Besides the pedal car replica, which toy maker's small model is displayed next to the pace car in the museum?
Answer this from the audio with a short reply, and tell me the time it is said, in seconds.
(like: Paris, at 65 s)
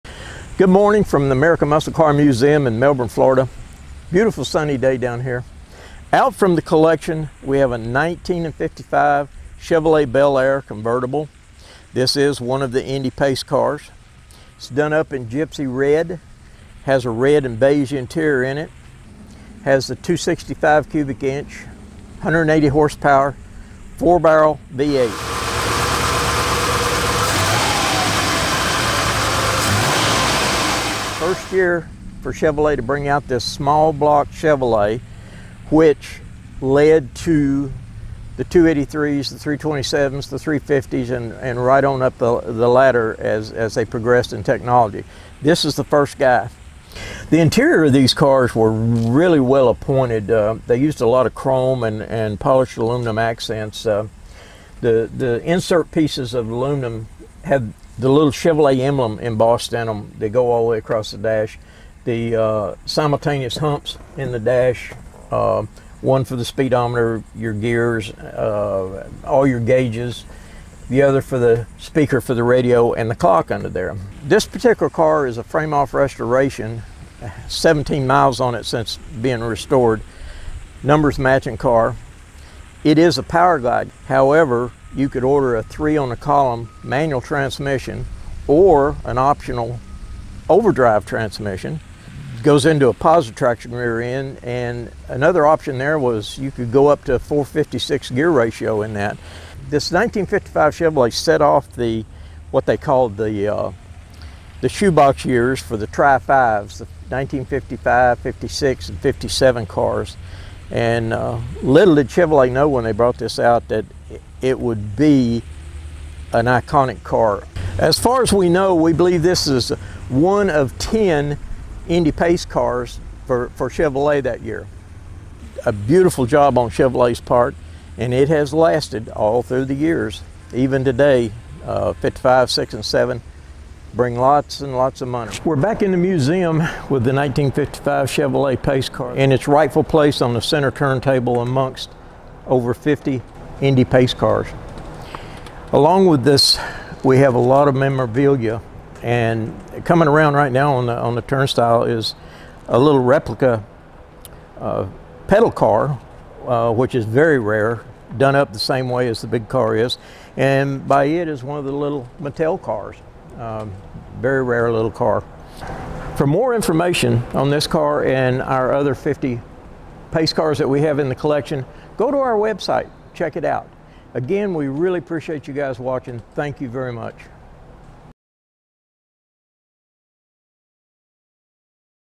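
Mattel, at 162 s.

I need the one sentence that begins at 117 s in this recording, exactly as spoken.
As far as we know, we believe this is one of 10 Indy Pace cars for, for Chevrolet that year.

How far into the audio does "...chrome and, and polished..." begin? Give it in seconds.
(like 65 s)
51 s.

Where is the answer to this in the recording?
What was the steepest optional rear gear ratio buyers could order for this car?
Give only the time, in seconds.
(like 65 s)
97 s.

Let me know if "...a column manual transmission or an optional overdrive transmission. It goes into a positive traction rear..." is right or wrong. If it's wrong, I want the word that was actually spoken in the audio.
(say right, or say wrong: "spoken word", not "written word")
right.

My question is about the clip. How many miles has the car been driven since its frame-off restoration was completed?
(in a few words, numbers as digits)
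17.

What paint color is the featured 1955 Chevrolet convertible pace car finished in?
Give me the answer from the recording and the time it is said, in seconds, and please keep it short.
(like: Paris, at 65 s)
Gypsy red, at 15 s.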